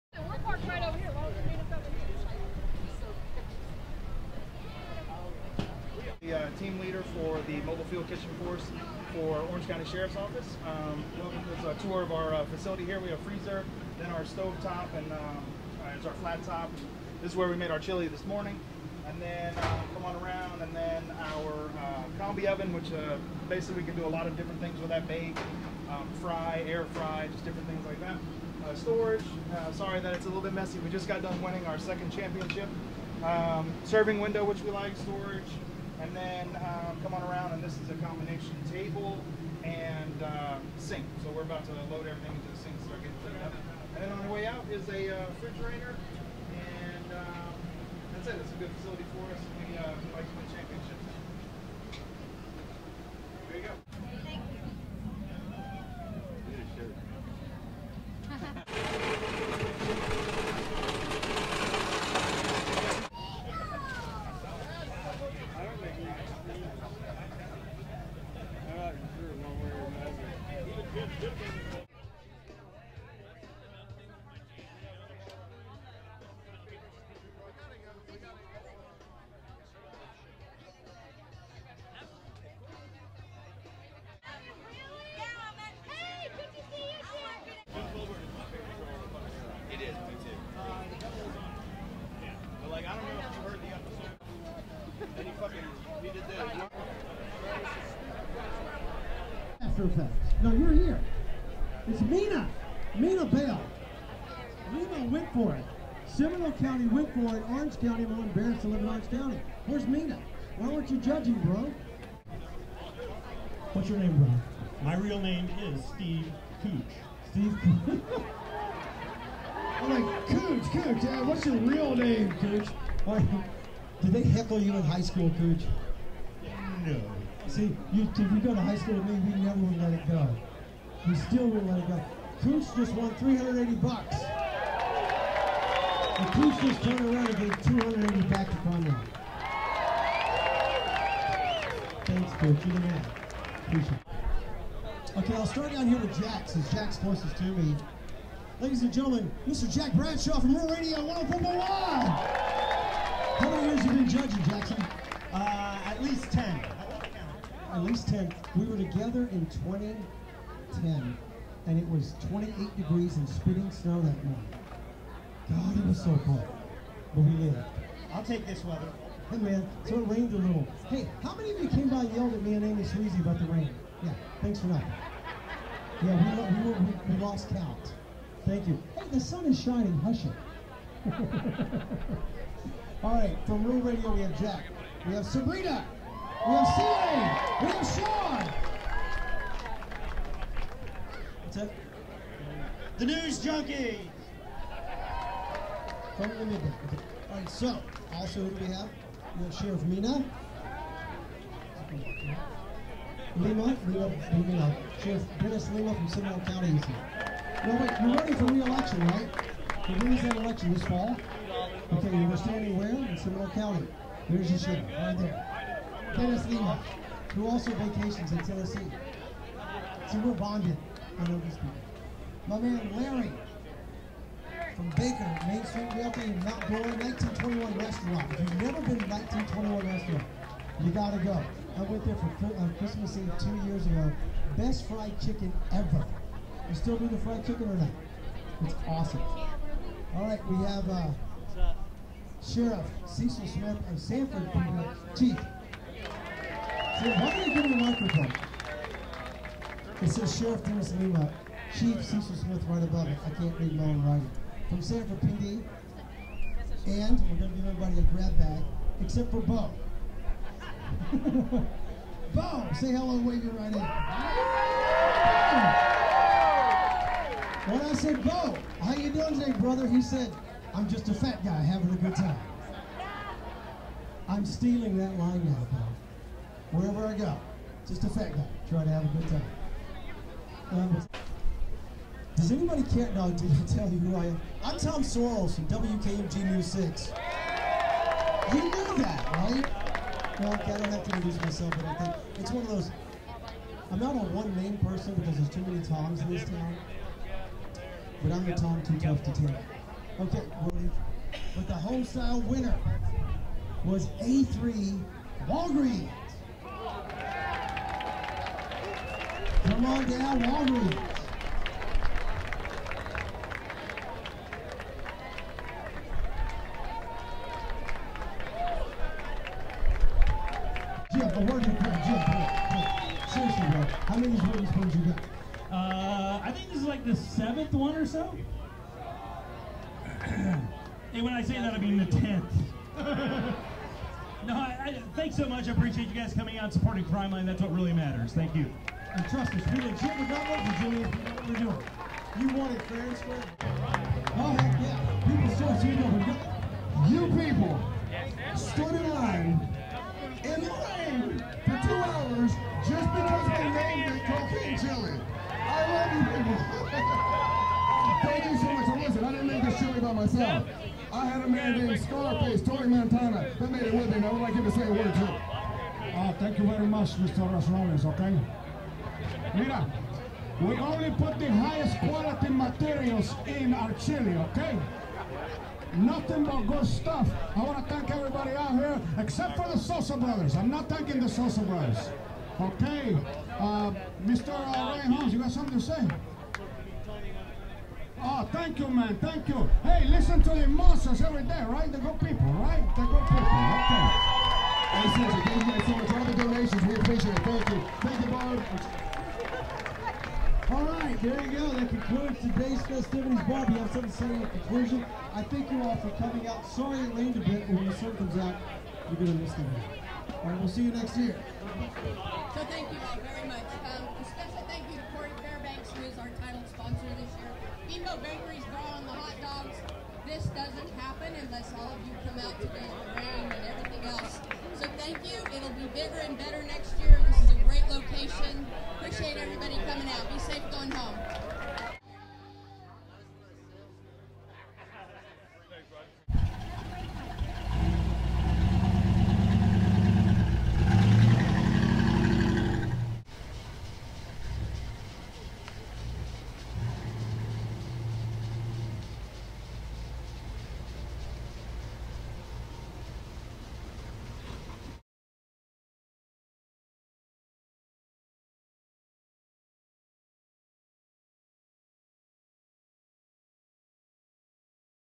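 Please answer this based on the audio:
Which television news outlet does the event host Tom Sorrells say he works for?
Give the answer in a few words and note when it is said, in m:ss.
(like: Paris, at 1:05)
WKMG News 6, at 4:45.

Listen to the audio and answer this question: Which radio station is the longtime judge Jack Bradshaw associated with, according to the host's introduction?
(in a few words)
Real Radio 104.1.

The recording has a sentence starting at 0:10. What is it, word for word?
Um, to a tour of our uh, facility here.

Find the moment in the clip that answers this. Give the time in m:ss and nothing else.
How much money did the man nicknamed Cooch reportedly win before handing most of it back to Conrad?
2:13.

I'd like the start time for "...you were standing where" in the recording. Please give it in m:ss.
3:32.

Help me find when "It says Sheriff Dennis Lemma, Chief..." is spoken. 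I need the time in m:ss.
4:10.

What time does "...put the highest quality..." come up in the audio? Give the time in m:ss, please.
6:11.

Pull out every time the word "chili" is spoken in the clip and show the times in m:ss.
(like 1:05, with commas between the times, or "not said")
0:17, 6:13.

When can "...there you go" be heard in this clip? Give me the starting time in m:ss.
6:41.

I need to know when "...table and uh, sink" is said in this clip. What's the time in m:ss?
0:38.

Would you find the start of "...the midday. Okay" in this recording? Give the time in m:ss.
3:16.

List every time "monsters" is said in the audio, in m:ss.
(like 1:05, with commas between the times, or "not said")
6:30.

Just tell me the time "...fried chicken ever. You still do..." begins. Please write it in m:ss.
3:54.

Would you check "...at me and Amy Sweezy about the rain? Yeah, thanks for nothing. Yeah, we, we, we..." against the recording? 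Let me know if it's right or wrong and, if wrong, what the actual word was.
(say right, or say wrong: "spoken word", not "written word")
right.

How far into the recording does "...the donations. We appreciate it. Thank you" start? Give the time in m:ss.
6:36.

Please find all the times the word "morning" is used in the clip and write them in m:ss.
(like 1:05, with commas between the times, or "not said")
0:18, 2:44.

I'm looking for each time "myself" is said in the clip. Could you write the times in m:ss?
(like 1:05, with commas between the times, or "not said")
4:51, 6:00.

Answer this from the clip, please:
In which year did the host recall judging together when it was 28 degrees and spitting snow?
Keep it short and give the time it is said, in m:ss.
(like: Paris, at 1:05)
2010, at 2:39.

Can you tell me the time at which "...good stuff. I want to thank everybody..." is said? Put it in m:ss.
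6:16.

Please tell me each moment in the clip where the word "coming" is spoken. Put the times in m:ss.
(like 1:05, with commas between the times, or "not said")
5:36, 6:46, 7:09.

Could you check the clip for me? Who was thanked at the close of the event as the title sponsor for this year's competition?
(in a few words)
Corey Fairbanks.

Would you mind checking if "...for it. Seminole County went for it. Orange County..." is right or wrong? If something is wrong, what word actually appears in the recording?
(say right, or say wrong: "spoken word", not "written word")
right.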